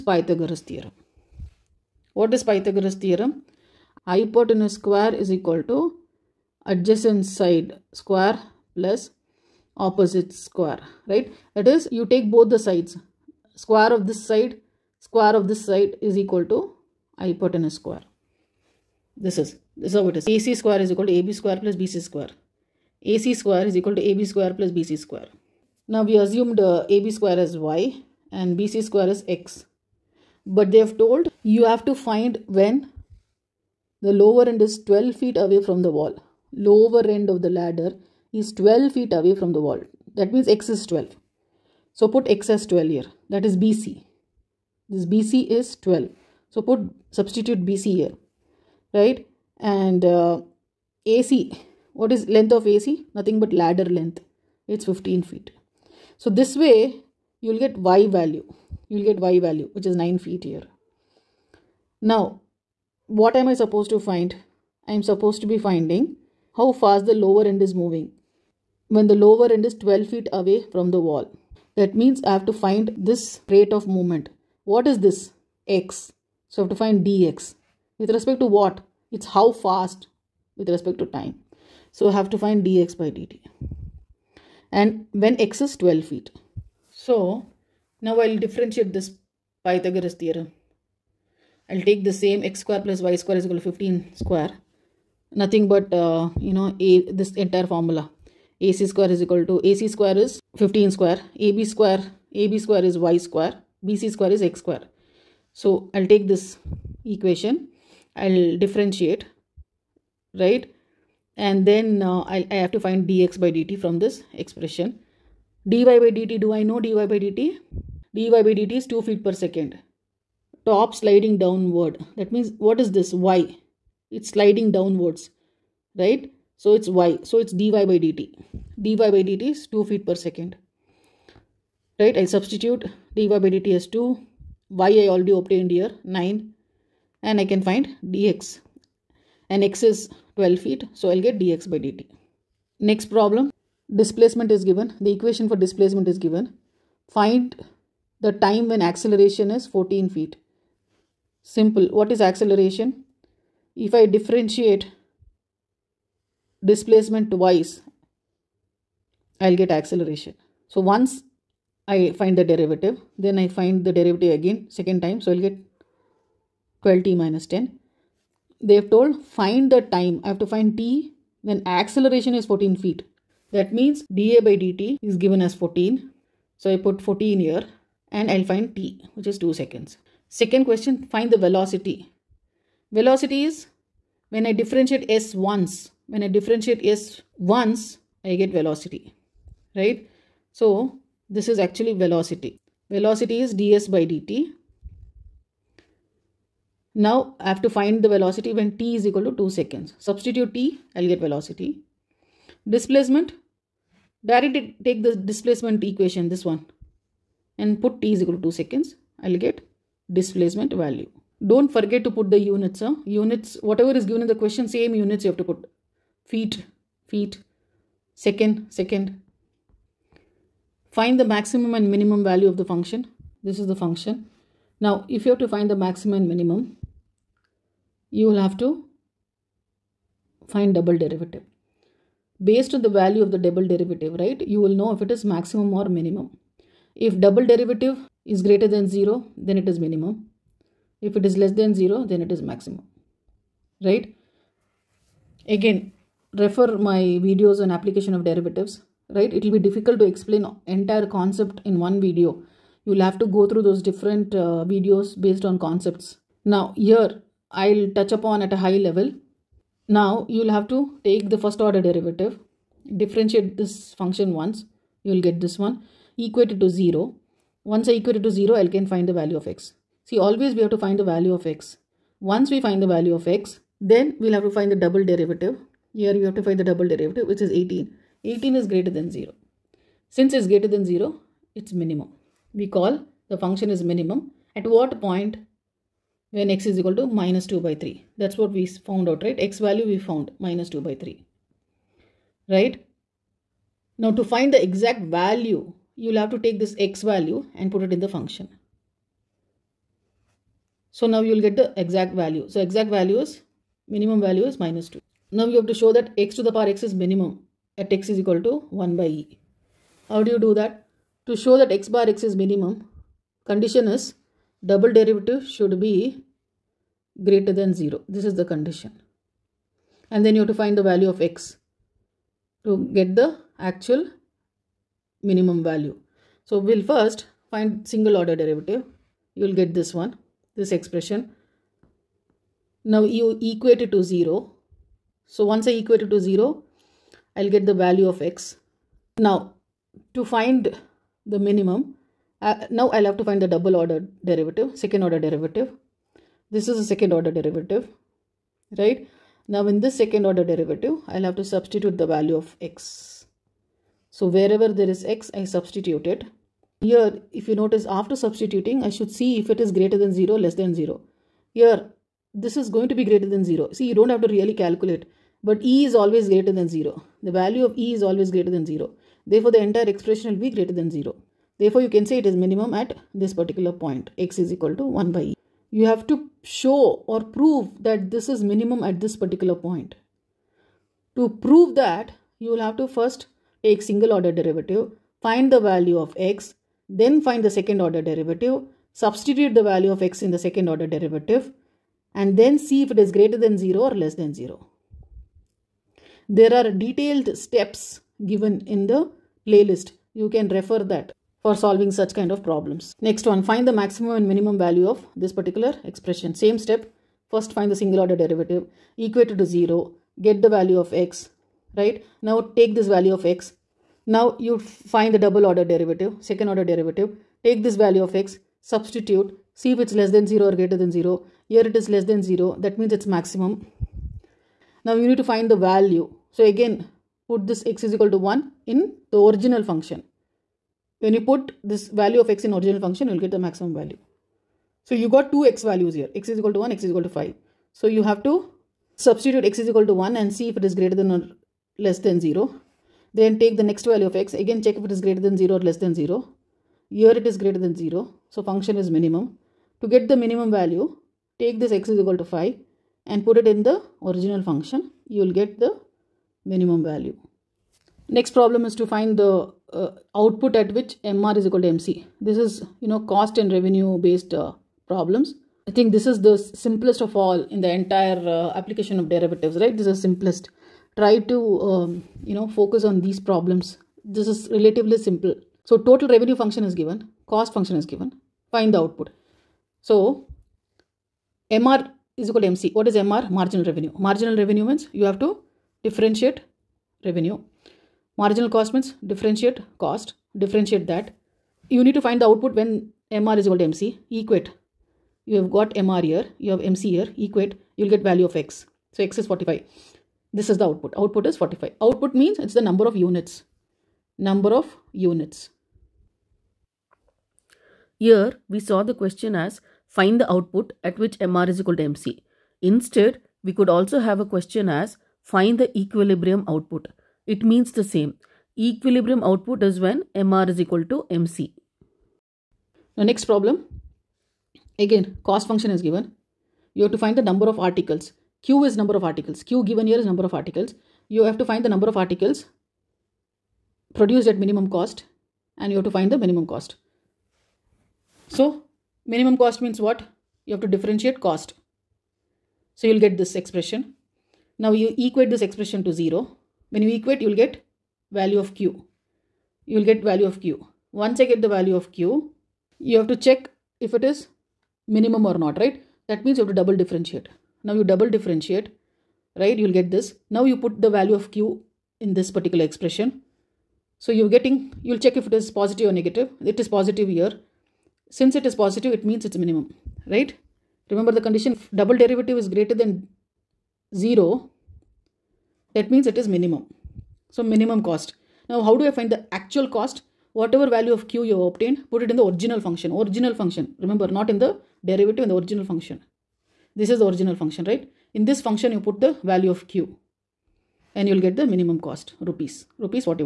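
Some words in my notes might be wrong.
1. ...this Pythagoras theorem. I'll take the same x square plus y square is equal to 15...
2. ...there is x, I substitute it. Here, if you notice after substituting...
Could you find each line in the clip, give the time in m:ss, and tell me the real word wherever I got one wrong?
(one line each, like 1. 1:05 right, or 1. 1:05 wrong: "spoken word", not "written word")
1. 1:28 right
2. 5:54 right.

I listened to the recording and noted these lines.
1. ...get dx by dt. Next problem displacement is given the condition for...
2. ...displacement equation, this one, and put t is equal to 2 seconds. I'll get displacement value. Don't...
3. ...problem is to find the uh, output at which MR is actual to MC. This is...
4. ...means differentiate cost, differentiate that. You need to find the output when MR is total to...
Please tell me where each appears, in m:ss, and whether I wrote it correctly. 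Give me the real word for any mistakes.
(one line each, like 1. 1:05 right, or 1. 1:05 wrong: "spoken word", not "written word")
1. 2:21 wrong: "equation", not "condition"
2. 3:25 right
3. 7:38 wrong: "equal", not "actual"
4. 8:08 wrong: "equal", not "total".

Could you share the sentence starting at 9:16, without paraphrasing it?
That means you have to double differentiate.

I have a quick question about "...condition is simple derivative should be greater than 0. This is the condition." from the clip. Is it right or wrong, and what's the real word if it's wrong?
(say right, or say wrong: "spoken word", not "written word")
wrong: "double", not "simple".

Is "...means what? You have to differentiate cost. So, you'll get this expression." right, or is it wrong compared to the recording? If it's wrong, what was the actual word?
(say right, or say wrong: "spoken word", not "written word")
right.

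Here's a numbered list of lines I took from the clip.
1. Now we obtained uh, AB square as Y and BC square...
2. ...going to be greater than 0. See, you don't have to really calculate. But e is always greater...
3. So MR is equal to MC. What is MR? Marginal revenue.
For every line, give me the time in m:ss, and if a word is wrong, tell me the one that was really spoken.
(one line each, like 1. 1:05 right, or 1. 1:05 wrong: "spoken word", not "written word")
1. 0:25 wrong: "assumed", not "obtained"
2. 6:02 right
3. 7:59 right.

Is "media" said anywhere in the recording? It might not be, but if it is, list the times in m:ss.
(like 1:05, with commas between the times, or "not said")
not said.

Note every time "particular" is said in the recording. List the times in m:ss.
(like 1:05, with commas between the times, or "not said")
6:13, 6:19, 6:45, 9:22.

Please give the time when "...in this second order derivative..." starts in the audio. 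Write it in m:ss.
5:49.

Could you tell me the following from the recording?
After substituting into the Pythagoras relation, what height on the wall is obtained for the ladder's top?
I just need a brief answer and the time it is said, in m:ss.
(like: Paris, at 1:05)
9 feet, at 0:59.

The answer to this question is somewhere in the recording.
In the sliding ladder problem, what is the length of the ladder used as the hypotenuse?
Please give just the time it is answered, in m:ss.
0:54.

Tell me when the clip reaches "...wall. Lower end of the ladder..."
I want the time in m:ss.
0:35.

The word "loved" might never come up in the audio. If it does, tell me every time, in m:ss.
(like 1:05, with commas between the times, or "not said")
not said.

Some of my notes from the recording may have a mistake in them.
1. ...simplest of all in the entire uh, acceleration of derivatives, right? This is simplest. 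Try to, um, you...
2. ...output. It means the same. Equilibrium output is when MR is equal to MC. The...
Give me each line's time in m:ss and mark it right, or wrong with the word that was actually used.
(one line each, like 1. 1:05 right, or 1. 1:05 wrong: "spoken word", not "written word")
1. 7:46 wrong: "application", not "acceleration"
2. 8:36 right.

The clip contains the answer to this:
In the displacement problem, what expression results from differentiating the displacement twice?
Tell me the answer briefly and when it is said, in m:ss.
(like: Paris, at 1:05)
12t - 10, at 2:46.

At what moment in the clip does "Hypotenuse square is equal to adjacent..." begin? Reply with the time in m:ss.
0:04.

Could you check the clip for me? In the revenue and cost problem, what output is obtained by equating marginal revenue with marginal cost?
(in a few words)
45.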